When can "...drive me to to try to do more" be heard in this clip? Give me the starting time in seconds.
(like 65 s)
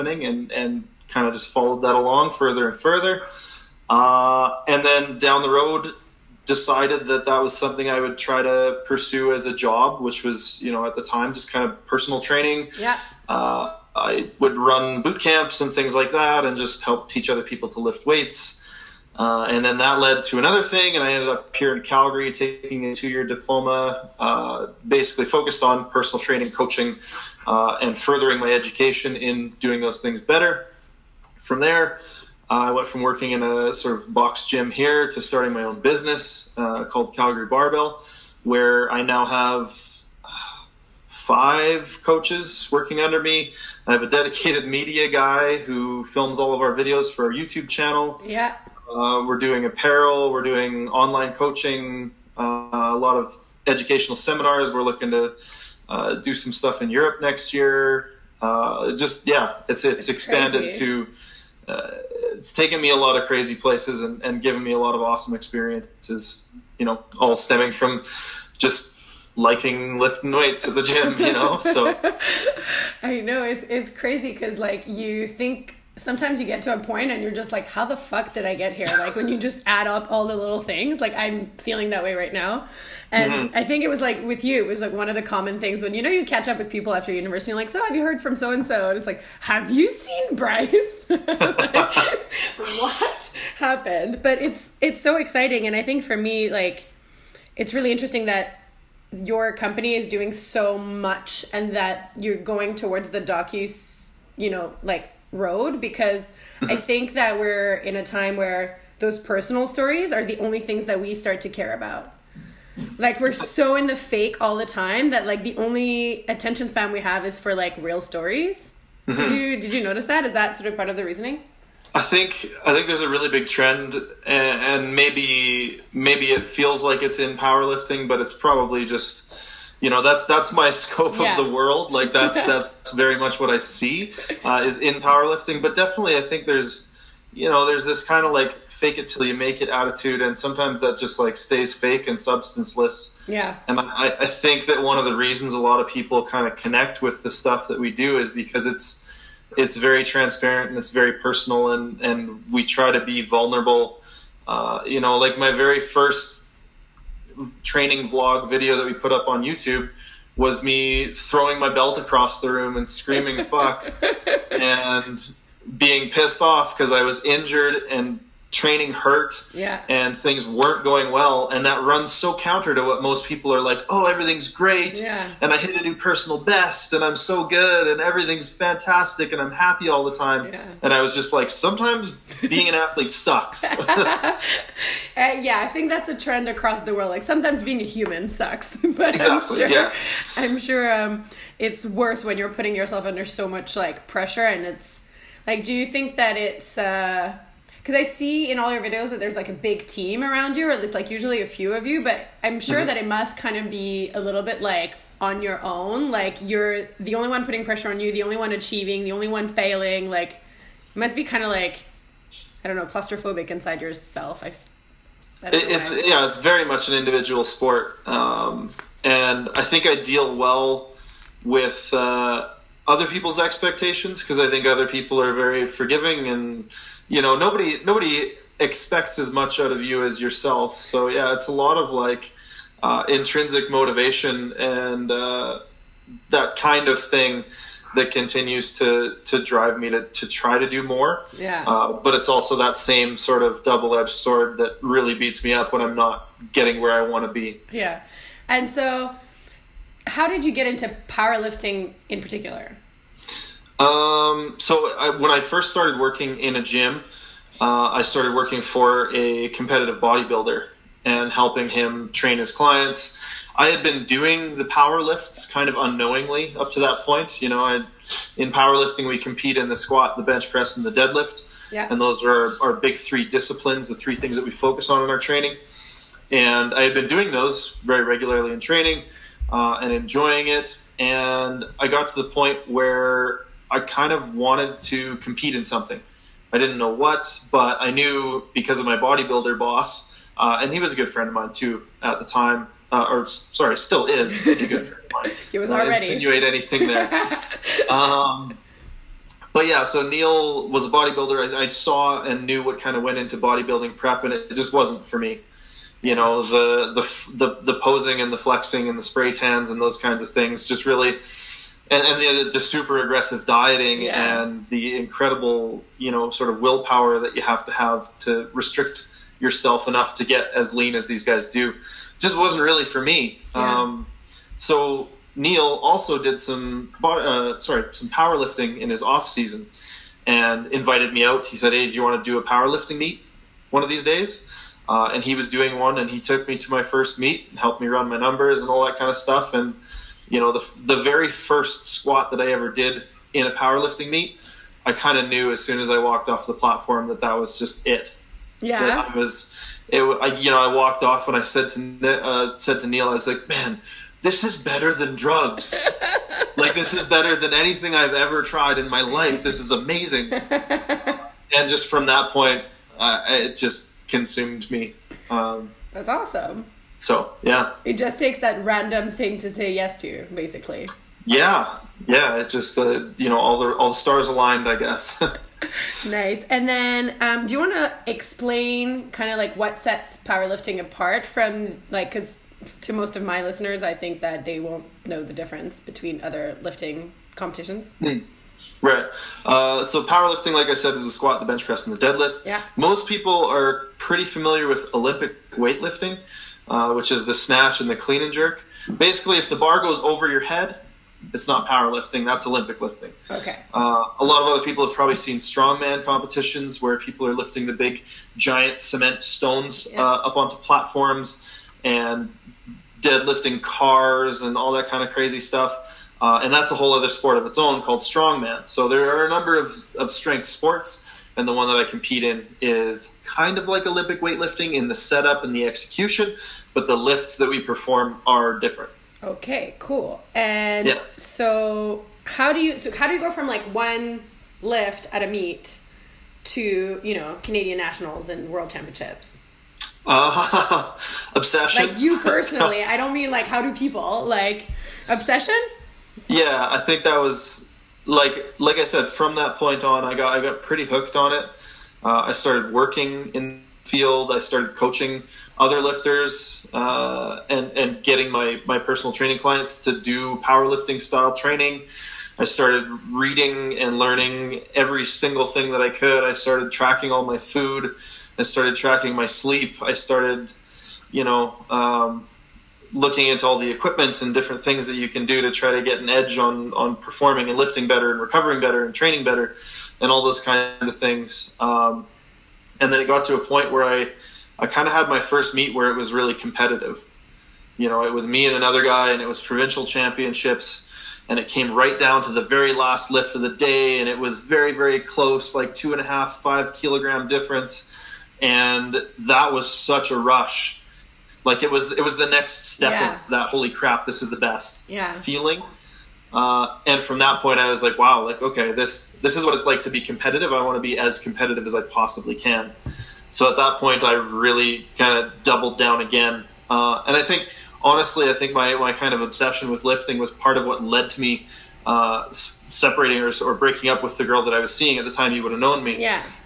239 s.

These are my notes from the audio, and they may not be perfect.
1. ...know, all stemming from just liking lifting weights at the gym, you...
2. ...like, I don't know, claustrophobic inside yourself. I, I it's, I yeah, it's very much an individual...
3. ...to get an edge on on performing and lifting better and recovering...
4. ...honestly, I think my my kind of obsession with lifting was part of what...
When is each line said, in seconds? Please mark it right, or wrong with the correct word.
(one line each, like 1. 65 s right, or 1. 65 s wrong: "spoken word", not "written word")
1. 66 s right
2. 211 s right
3. 475 s right
4. 517 s right.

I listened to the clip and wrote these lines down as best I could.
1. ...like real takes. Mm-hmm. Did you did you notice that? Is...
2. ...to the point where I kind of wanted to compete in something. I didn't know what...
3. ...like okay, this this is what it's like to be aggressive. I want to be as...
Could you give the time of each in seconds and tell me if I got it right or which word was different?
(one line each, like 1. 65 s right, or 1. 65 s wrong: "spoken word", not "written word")
1. 117 s wrong: "stories", not "takes"
2. 282 s right
3. 508 s wrong: "competitive", not "aggressive".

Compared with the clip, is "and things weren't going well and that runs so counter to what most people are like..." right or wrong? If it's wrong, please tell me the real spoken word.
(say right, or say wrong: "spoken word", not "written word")
right.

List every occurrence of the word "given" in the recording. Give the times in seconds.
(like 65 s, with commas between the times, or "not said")
64 s.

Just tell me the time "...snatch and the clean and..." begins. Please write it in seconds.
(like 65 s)
397 s.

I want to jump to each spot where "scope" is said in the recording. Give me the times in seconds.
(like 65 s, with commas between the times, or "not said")
130 s.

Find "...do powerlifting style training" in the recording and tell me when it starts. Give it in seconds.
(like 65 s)
460 s.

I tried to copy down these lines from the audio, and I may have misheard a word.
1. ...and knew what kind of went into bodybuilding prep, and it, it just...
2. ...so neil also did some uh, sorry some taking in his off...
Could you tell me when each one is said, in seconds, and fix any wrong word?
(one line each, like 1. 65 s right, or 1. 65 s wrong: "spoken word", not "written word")
1. 302 s right
2. 324 s wrong: "powerlifting", not "taking".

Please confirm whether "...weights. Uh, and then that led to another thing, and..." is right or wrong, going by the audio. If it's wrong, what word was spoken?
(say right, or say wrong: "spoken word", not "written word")
right.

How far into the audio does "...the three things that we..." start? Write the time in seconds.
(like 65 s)
273 s.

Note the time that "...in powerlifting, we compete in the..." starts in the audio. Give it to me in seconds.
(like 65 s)
268 s.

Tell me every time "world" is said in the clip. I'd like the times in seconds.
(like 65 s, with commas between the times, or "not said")
131 s, 186 s, 438 s.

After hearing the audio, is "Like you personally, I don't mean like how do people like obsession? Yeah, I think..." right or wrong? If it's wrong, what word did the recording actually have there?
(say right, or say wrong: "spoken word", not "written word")
right.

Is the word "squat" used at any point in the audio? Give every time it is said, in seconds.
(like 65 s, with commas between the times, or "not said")
269 s, 341 s, 391 s.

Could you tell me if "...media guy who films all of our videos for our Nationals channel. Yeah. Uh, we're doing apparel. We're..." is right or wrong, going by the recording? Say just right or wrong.
wrong.